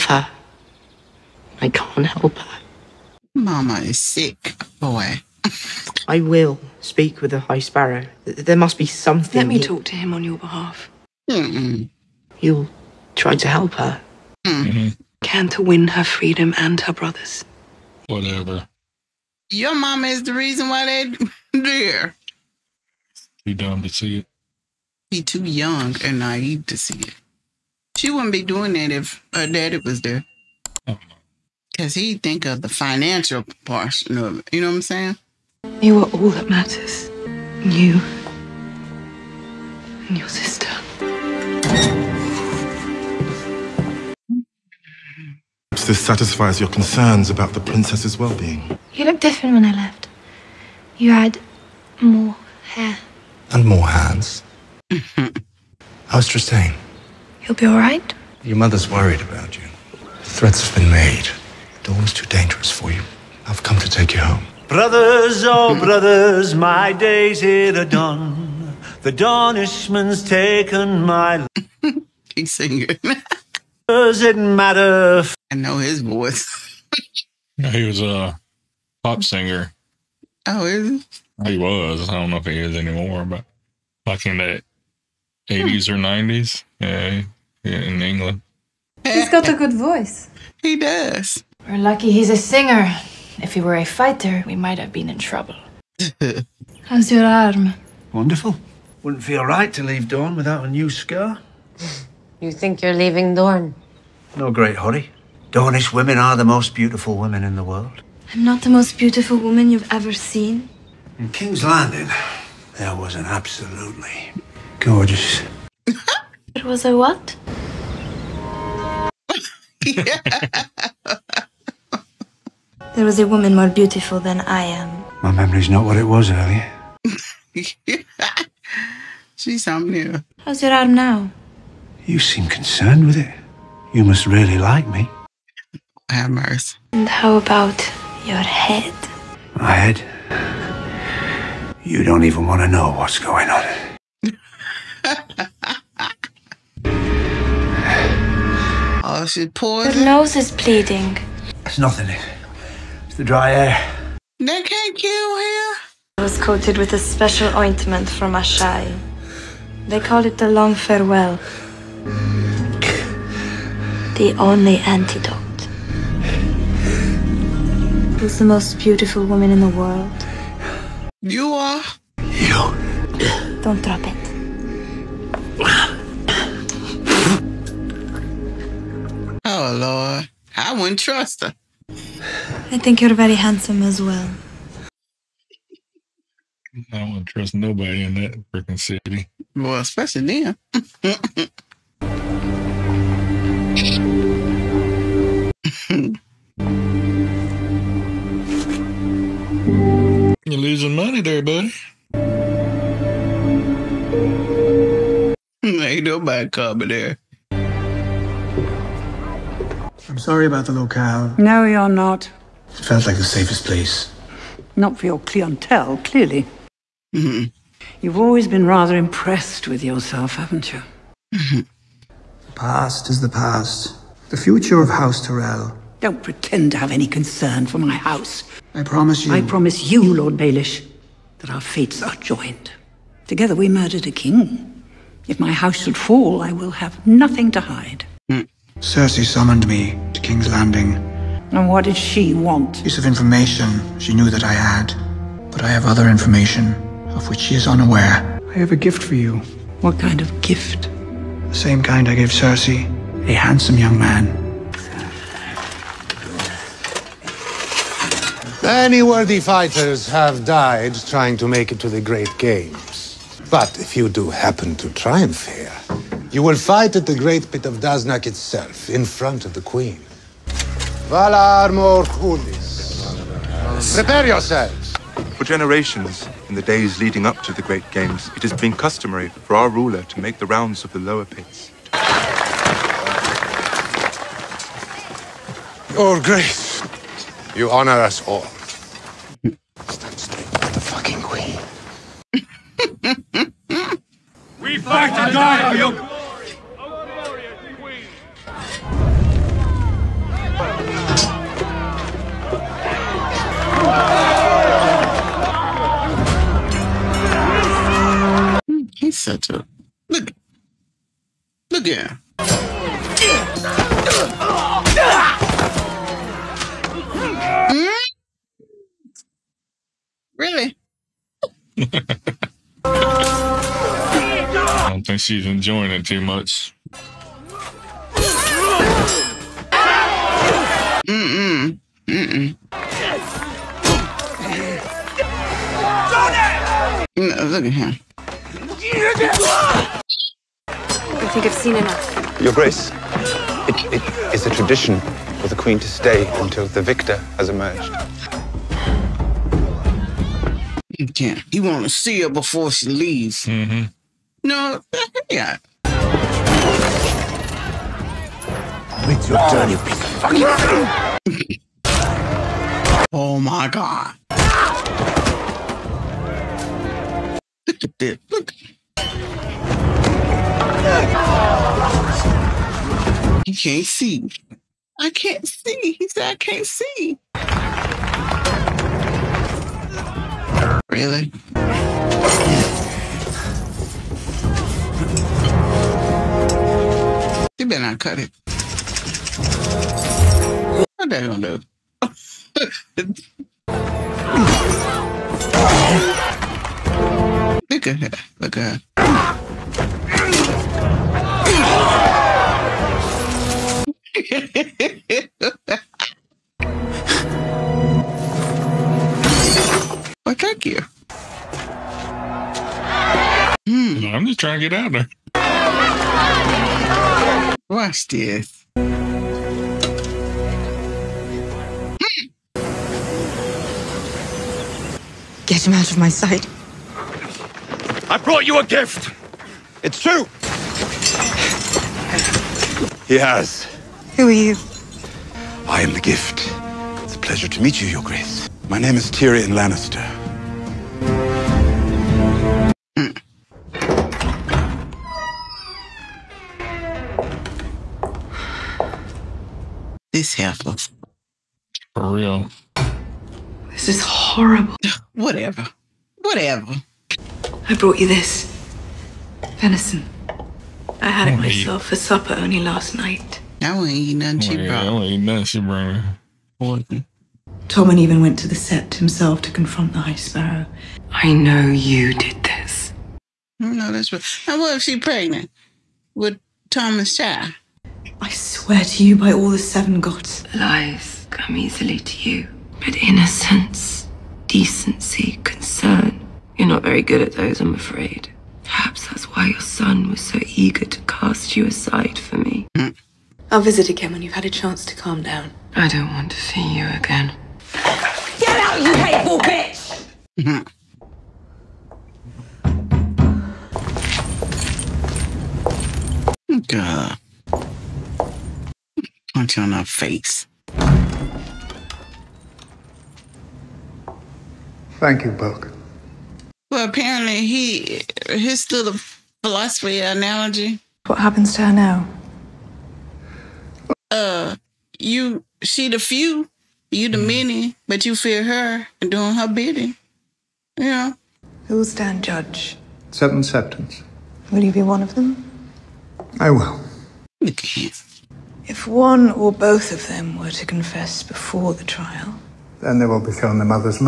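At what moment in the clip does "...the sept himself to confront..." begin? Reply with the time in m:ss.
7:48.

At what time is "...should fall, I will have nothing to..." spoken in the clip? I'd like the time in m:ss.
3:55.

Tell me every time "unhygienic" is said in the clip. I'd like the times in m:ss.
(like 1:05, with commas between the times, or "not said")
not said.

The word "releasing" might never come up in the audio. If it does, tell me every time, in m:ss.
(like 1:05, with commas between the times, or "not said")
not said.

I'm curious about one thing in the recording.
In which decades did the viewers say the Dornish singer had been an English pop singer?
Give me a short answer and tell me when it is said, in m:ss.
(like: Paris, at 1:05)
80s or 90s, at 1:25.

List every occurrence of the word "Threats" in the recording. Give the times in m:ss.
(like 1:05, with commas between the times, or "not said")
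1:00.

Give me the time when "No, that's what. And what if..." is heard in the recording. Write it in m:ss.
7:53.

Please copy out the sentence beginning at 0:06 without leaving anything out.
I will speak with the High Sparrow.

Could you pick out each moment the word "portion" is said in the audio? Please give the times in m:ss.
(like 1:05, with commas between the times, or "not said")
0:33.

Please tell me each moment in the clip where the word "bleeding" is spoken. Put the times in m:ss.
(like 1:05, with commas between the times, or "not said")
2:30.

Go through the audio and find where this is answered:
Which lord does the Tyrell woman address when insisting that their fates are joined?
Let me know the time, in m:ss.
3:50.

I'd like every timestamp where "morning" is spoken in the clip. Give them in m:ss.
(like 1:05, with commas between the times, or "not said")
not said.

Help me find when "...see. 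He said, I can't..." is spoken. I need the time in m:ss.
6:15.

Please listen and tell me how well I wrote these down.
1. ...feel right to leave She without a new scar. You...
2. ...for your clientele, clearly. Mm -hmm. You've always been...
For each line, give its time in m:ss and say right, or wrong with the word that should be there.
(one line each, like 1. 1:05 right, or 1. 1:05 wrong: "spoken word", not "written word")
1. 1:39 wrong: "Dorne", not "She"
2. 3:34 right.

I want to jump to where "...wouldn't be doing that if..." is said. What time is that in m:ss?
0:28.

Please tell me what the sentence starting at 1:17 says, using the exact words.
yeah, he was a pop singer.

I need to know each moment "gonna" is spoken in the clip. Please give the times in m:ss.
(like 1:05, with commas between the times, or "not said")
6:31.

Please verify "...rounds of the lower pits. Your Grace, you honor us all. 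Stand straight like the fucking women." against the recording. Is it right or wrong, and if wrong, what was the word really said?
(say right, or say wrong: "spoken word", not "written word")
wrong: "queen", not "women".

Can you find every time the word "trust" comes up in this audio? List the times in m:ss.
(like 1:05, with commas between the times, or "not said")
3:00, 3:07.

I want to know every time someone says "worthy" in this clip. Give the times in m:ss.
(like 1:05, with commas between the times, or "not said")
4:19.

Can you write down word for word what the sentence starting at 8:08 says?
Perhaps that's why your son was so eager to cast you aside for me.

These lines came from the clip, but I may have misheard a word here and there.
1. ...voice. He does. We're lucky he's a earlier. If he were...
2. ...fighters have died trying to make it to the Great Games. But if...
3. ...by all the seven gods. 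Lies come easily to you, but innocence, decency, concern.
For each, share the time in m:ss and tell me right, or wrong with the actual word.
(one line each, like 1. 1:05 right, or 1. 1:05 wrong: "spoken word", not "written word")
1. 1:29 wrong: "singer", not "earlier"
2. 4:19 right
3. 7:59 right.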